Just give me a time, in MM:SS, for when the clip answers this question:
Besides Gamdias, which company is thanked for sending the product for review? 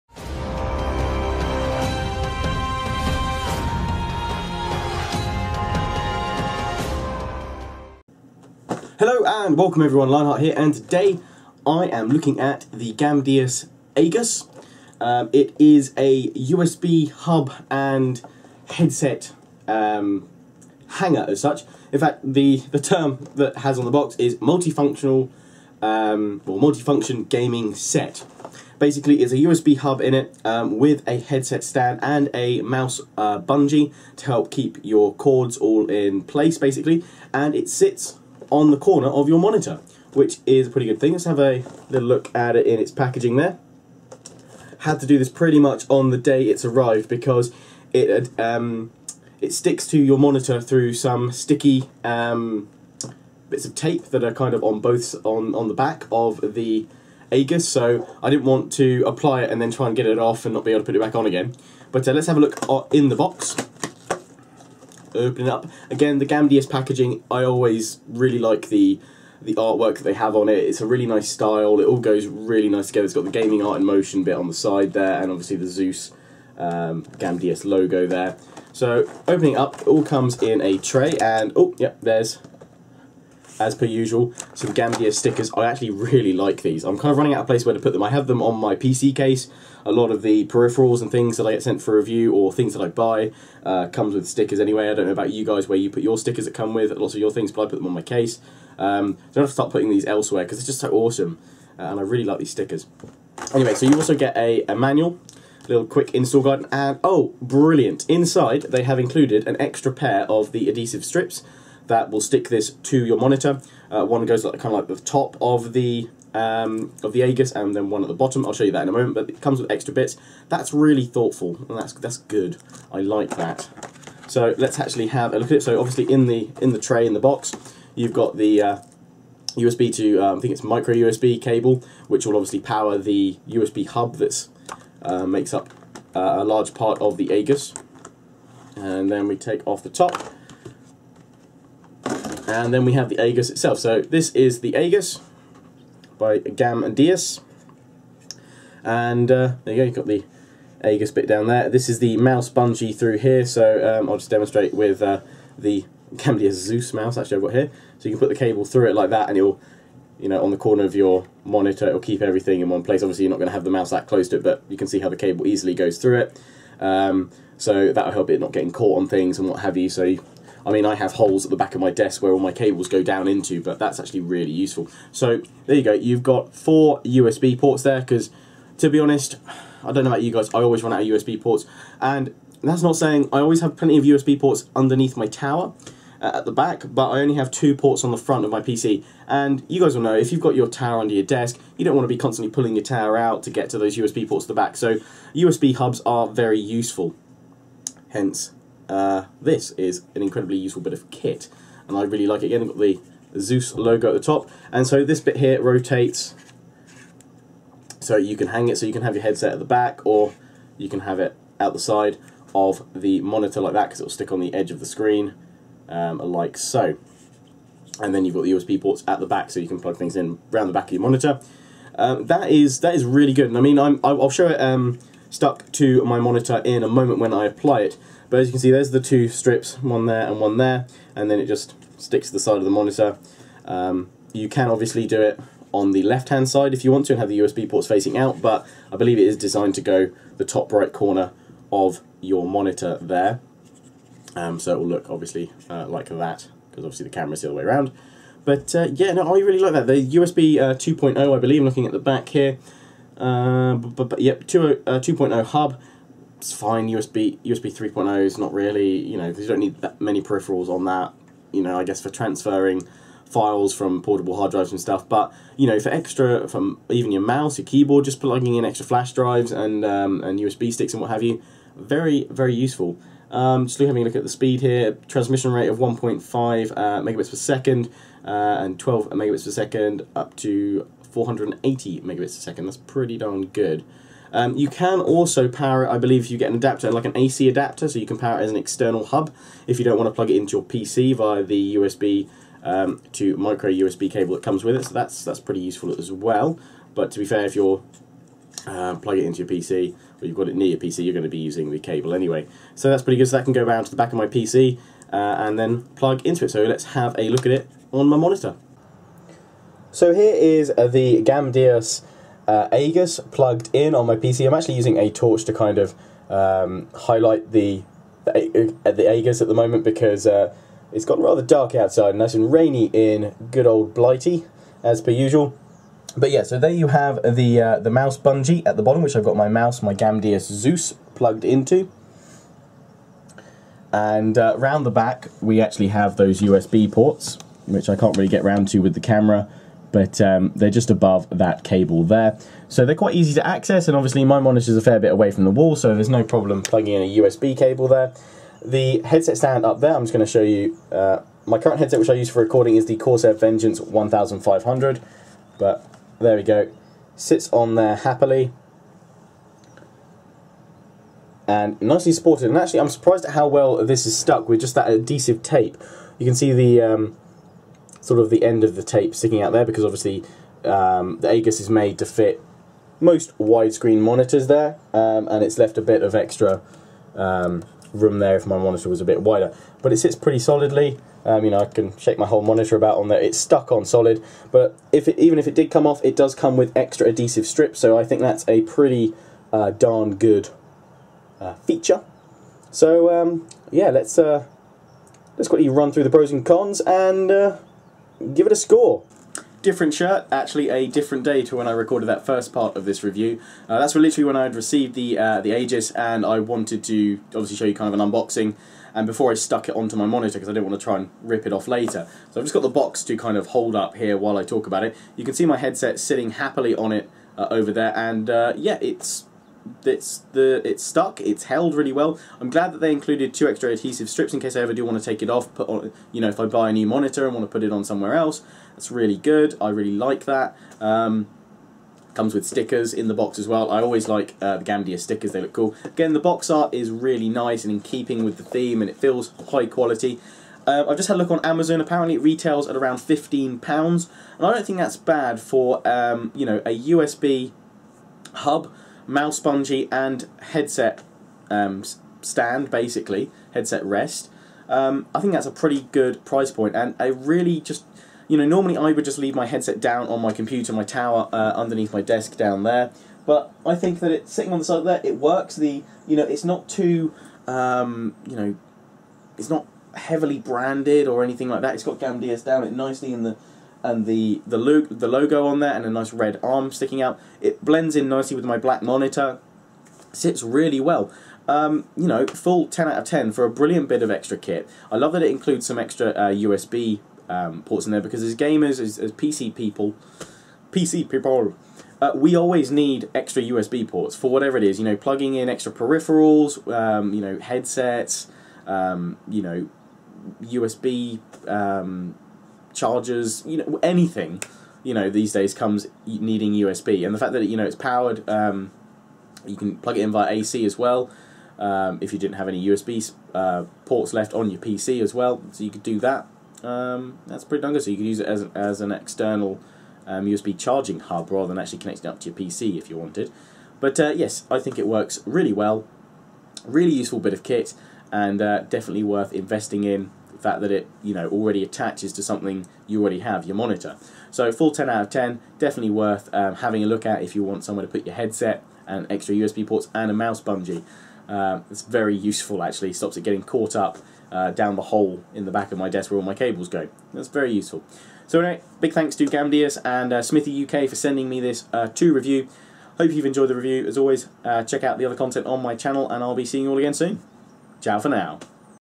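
09:10.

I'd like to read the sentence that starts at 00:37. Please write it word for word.
And it sits on the corner of your monitor, which is a pretty good thing.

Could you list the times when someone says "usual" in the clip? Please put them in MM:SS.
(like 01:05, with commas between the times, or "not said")
01:23, 05:25.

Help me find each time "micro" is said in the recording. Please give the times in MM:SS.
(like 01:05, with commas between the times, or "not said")
02:10, 04:53.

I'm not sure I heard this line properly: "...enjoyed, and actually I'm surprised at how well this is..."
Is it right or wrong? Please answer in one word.
wrong.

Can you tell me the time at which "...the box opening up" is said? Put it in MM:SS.
01:03.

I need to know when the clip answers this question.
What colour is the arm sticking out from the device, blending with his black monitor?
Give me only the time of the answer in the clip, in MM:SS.
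07:56.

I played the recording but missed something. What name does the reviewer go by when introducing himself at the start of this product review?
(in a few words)
Lionheart.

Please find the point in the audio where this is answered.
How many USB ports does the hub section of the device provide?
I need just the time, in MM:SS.
02:56.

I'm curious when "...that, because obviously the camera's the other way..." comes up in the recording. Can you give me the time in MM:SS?
04:06.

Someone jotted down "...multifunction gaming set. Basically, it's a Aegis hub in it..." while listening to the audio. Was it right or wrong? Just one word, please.
wrong.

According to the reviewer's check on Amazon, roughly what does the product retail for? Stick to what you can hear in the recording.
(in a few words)
£15.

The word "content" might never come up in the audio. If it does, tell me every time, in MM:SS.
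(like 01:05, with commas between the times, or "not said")
09:15.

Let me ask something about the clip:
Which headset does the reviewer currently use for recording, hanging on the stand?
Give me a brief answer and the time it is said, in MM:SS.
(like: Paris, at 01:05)
Corsair Vengeance 1500, at 05:52.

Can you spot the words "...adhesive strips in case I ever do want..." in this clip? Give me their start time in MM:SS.
07:03.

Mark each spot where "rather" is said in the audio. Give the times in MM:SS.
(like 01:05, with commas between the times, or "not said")
05:21, 08:41.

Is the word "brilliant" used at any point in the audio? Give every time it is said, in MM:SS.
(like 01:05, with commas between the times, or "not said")
01:47, 08:03.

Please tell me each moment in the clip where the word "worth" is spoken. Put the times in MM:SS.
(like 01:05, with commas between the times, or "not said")
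08:49, 08:55.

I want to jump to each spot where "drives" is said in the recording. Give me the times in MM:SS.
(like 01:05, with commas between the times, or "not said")
04:24, 04:29.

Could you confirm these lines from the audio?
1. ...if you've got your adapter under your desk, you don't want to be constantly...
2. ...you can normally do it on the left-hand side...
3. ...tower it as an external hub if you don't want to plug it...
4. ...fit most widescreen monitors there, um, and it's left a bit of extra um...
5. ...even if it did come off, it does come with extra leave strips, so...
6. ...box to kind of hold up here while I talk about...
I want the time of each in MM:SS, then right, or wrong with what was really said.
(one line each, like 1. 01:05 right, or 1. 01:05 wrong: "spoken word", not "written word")
1. 03:10 wrong: "tower", not "adapter"
2. 03:54 wrong: "obviously", not "normally"
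3. 04:48 wrong: "power", not "tower"
4. 06:12 right
5. 06:25 wrong: "adhesive", not "leave"
6. 06:52 right.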